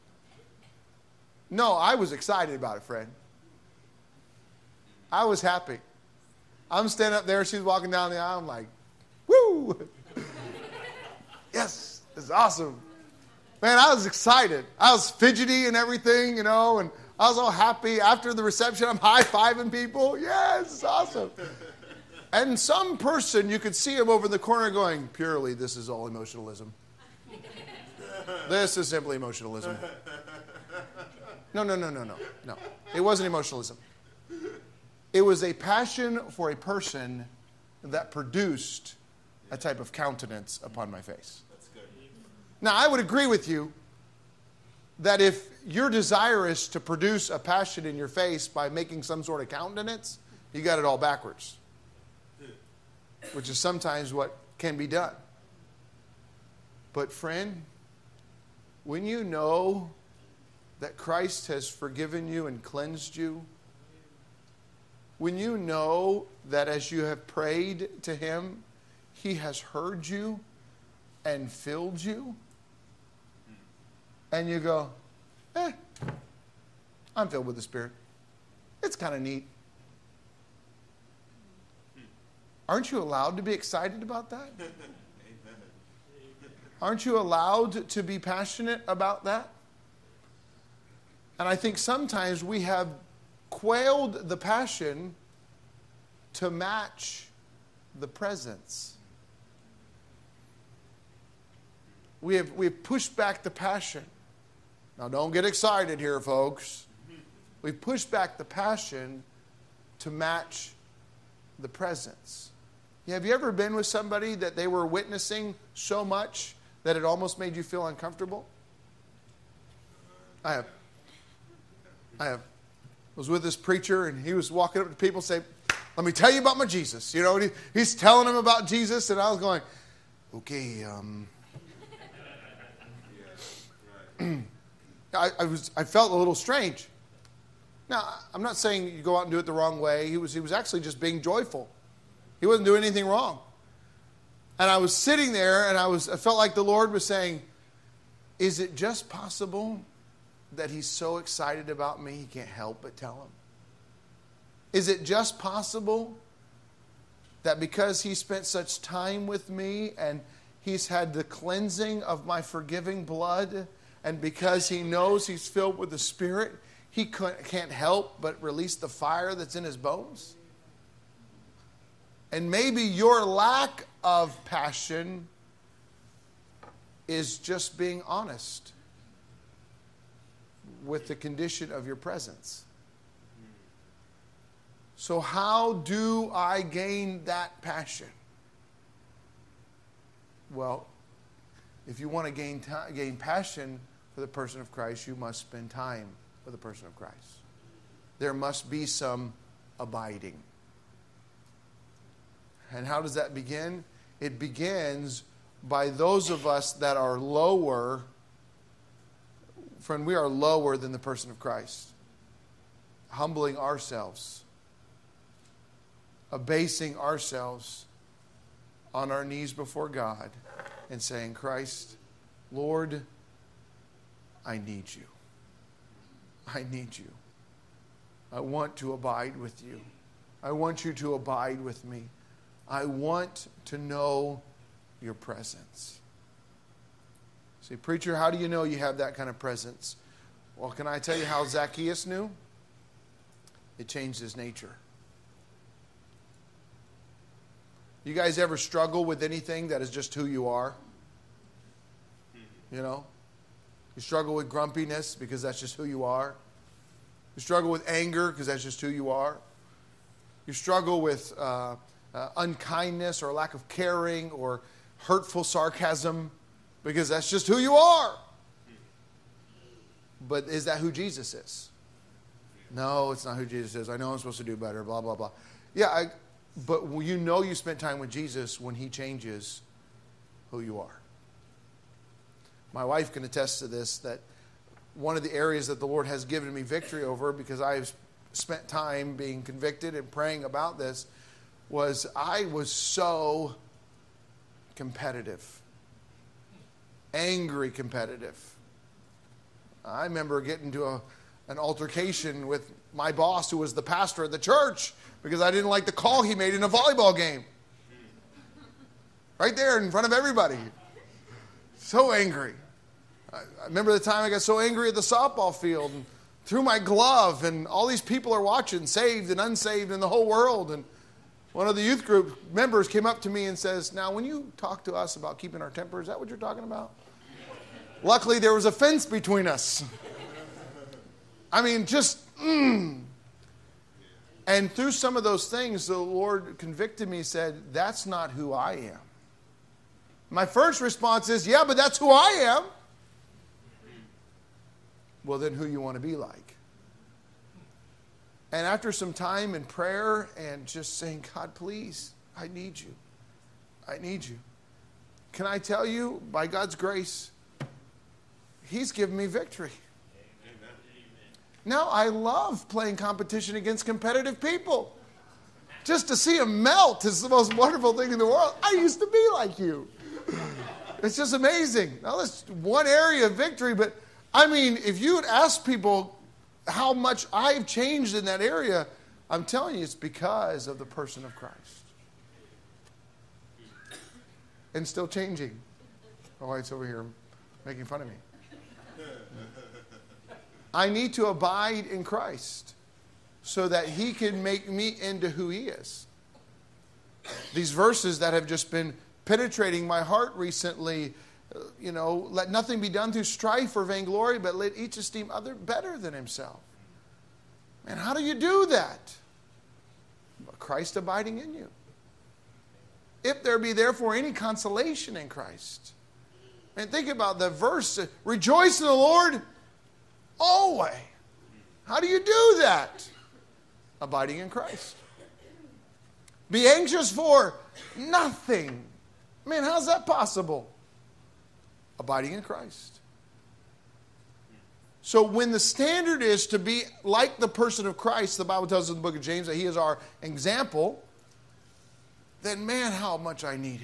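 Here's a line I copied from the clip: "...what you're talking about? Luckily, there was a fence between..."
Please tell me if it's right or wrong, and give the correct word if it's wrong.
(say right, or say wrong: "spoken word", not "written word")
right.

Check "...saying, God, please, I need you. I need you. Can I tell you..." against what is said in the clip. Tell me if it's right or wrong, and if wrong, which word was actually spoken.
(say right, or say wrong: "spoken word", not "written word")
right.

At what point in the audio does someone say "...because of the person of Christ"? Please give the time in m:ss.
6:19.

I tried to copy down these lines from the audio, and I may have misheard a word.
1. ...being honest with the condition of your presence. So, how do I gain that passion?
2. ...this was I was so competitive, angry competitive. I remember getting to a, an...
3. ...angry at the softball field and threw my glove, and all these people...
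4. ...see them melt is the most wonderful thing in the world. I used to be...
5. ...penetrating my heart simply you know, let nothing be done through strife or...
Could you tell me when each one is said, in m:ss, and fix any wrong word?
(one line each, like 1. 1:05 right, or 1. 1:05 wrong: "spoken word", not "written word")
1. 2:57 right
2. 4:50 right
3. 5:14 right
4. 6:06 right
5. 6:39 wrong: "recently", not "simply".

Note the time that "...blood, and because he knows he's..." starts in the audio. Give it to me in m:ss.
2:43.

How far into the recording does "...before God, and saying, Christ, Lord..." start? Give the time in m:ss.
3:39.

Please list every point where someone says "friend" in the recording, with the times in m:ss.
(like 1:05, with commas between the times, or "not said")
0:02, 0:57, 3:29.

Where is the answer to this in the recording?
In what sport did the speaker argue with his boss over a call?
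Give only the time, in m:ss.
5:06.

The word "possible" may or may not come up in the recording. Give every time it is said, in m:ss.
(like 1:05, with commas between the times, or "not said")
2:29, 2:35, 7:10.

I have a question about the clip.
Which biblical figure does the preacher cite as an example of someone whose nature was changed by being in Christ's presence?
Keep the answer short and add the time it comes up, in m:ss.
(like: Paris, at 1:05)
Zacchaeus, at 4:01.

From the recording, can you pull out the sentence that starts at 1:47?
We push back the passion to match the presence.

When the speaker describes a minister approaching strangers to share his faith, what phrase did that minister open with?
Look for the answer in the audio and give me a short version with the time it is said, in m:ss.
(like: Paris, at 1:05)
Let me tell you about my Jesus, at 2:05.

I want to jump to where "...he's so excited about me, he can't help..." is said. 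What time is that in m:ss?
2:30.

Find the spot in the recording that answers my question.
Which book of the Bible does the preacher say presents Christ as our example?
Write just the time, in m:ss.
7:19.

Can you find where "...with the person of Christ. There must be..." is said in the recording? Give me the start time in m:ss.
3:16.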